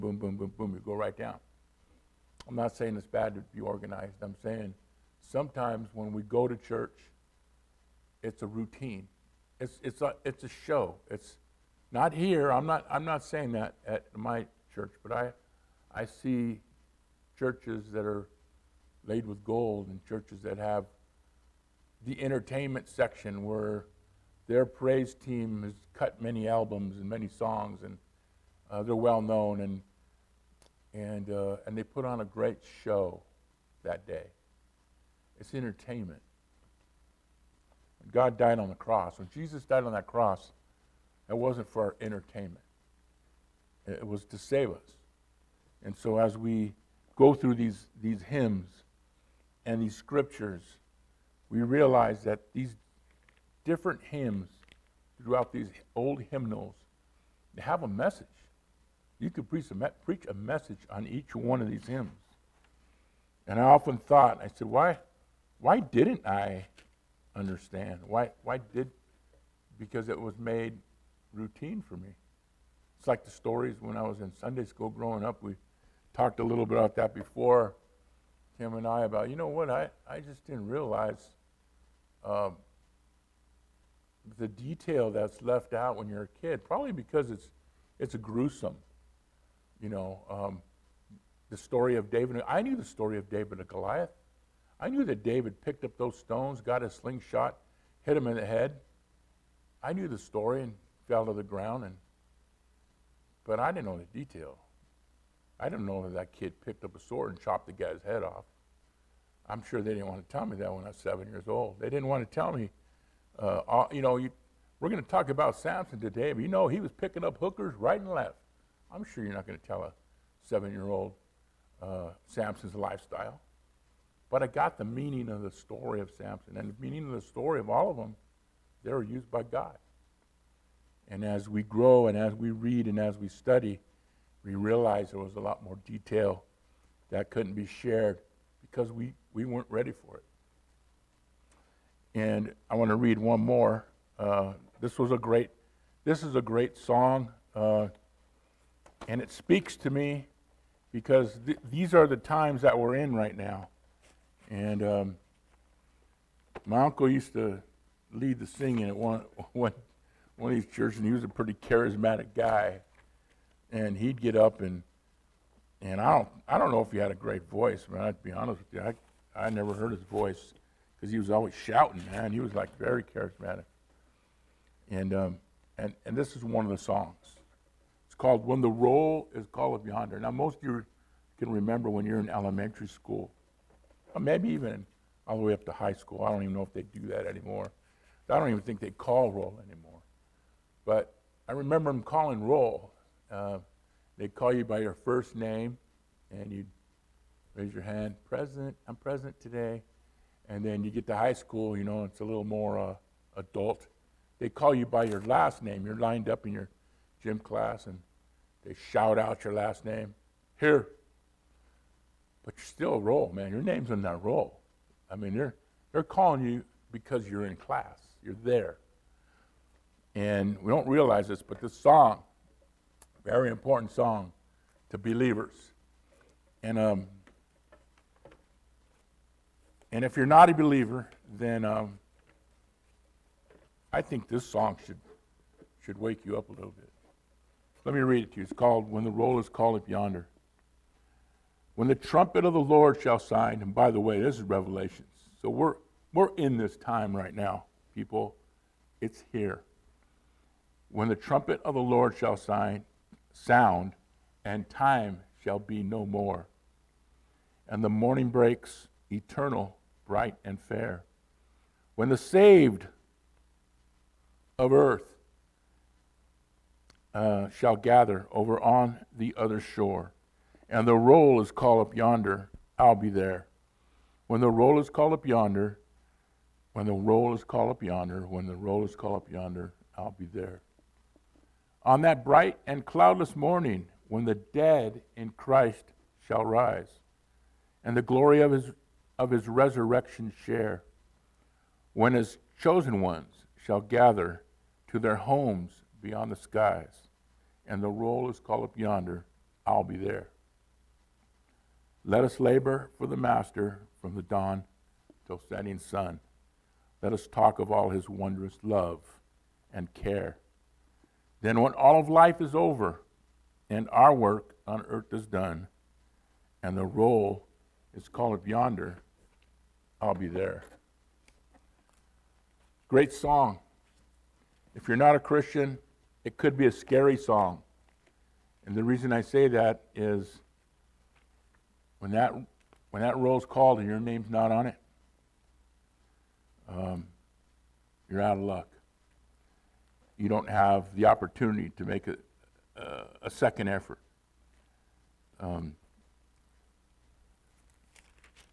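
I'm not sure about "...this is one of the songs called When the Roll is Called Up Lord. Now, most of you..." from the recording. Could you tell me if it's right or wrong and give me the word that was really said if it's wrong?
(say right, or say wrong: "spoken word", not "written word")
wrong: "Yonder", not "Lord".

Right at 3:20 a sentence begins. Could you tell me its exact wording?
And then you get to high school, you know, it's a little more uh, adult.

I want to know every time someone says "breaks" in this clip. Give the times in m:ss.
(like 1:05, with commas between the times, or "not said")
4:18.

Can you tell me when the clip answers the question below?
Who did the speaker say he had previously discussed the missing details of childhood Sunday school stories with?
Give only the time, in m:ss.
1:18.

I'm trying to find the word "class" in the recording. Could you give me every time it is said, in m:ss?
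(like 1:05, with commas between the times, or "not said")
3:27, 3:37.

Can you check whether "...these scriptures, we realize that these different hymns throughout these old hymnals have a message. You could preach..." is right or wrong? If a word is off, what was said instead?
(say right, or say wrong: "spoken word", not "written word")
right.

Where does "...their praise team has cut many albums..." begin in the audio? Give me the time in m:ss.
0:24.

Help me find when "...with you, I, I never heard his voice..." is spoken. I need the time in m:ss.
2:48.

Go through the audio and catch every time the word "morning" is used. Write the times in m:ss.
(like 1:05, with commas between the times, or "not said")
4:17, 4:43.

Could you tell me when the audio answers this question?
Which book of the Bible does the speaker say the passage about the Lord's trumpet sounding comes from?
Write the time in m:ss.
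4:04.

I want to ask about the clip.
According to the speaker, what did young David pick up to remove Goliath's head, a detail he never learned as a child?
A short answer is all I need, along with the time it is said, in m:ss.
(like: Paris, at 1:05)
A sword, at 1:46.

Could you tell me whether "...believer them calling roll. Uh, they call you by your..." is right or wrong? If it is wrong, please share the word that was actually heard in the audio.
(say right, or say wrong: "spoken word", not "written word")
wrong: "remember", not "believer".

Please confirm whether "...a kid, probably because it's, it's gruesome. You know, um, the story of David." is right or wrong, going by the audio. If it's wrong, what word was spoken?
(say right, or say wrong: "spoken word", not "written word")
right.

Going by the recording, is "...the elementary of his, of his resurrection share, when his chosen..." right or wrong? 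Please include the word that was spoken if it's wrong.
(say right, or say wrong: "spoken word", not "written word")
wrong: "glory", not "elementary".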